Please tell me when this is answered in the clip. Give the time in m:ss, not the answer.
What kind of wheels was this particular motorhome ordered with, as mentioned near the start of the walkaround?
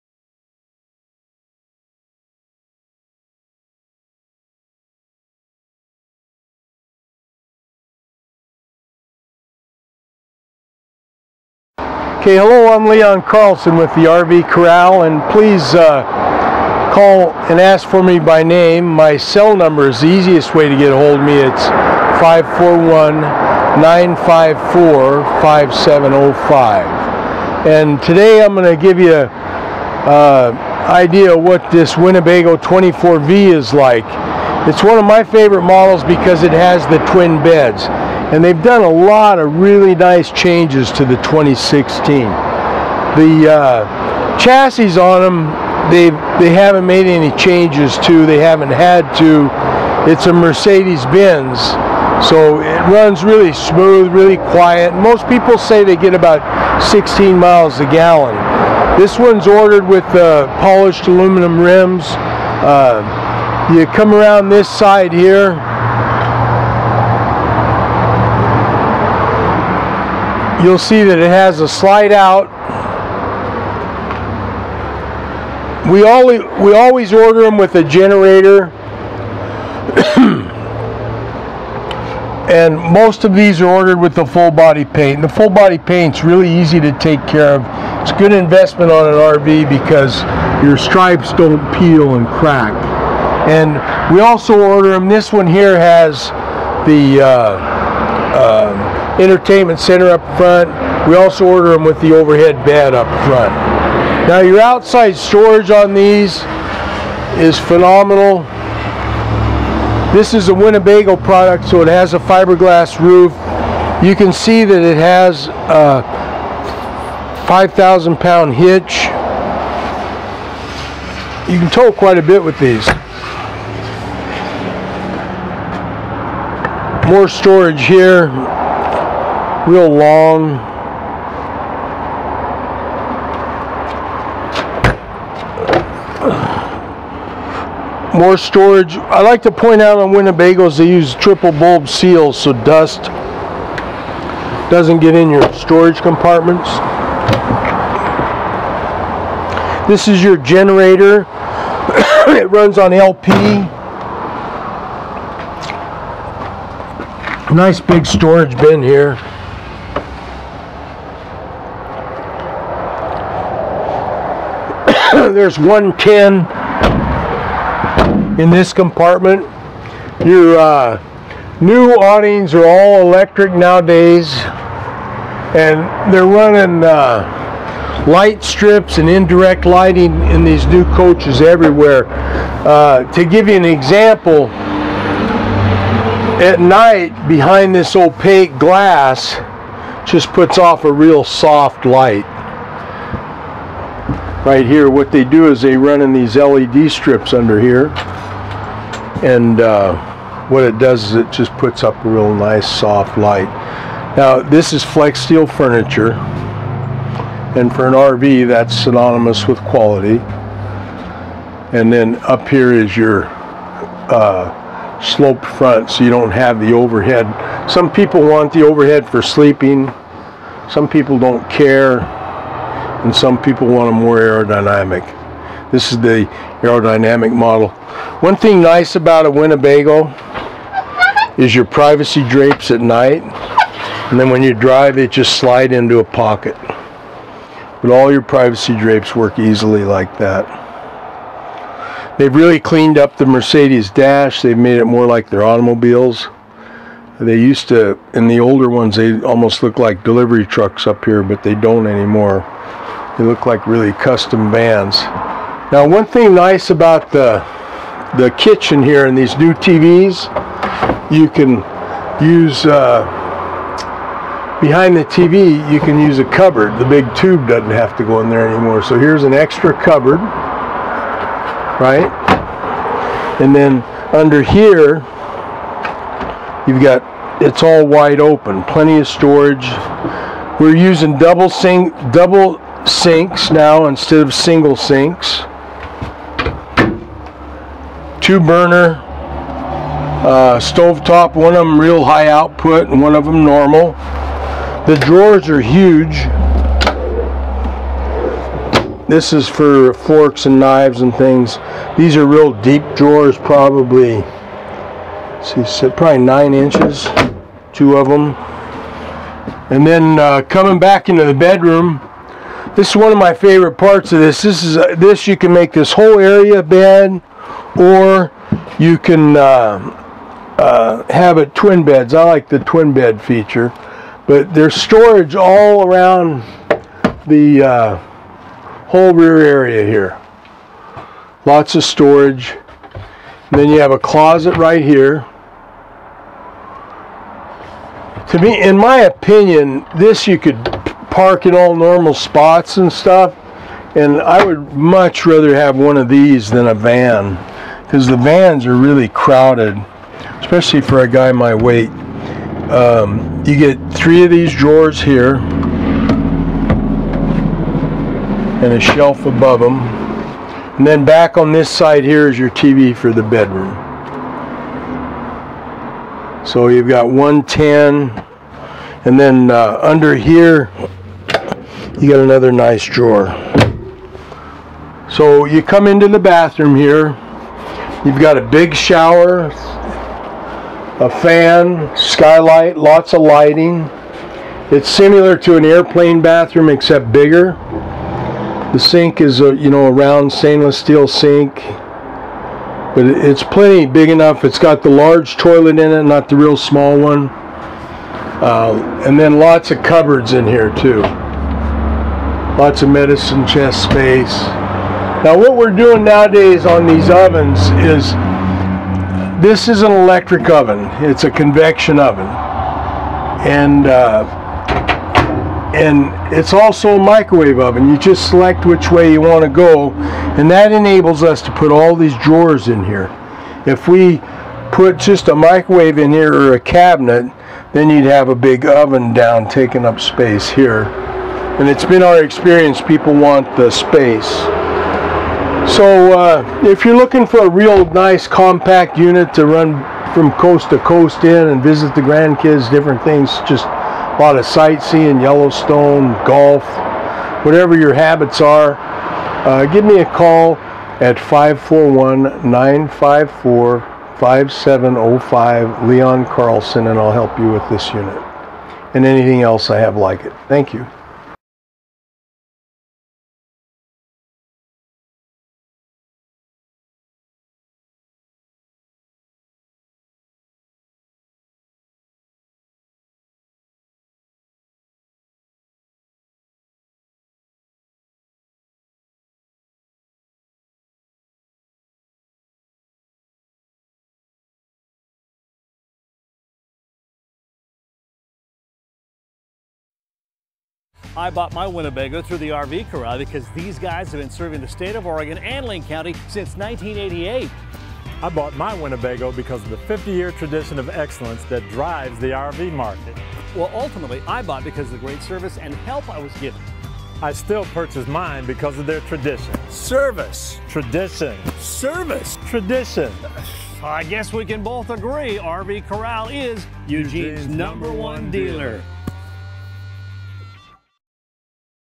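1:00.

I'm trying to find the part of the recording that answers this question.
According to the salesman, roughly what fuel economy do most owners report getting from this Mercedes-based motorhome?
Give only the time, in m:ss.
0:56.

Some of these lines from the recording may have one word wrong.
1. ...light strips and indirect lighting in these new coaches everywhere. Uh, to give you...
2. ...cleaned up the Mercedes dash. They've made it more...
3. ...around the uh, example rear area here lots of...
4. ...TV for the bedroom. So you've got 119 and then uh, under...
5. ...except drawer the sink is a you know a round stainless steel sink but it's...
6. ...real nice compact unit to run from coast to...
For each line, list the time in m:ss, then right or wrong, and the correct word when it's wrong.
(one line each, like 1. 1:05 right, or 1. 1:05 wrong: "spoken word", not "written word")
1. 2:58 right
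2. 4:02 right
3. 5:25 wrong: "whole", not "example"
4. 6:02 wrong: "110", not "119"
5. 6:26 wrong: "bigger", not "drawer"
6. 7:17 right.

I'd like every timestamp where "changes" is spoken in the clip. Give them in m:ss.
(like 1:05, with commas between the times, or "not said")
0:40, 0:47.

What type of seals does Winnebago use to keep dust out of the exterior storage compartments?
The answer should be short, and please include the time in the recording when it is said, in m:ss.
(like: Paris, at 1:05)
triple bulb seals, at 2:21.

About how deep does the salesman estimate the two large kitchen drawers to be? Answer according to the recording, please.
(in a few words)
9 inches.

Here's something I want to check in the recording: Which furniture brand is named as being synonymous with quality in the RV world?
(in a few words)
Flexsteel.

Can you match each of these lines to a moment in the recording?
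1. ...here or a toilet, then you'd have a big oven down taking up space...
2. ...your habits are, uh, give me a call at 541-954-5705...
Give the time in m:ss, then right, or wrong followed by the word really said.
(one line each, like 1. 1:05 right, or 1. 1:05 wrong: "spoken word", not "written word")
1. 7:06 wrong: "cabinet", not "toilet"
2. 7:27 right.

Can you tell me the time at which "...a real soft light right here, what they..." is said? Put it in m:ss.
3:10.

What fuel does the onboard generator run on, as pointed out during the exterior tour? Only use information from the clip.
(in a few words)
LP.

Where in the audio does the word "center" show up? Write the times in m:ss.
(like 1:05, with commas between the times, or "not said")
1:39.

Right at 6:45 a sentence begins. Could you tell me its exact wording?
Now what we're doing nowadays on these ovens is this is an electric oven.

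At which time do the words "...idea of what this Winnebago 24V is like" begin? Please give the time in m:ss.
0:30.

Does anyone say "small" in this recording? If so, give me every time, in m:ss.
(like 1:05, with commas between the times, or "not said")
6:36.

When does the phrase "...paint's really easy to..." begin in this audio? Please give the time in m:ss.
1:25.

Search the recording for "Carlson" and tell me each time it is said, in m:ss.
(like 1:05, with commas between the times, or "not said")
0:13, 7:36.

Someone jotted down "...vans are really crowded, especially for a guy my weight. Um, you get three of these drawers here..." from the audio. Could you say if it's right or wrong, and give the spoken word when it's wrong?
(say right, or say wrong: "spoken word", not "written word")
right.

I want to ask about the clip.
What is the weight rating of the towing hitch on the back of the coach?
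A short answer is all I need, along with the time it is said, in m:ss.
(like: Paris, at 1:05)
5,000 pound, at 1:57.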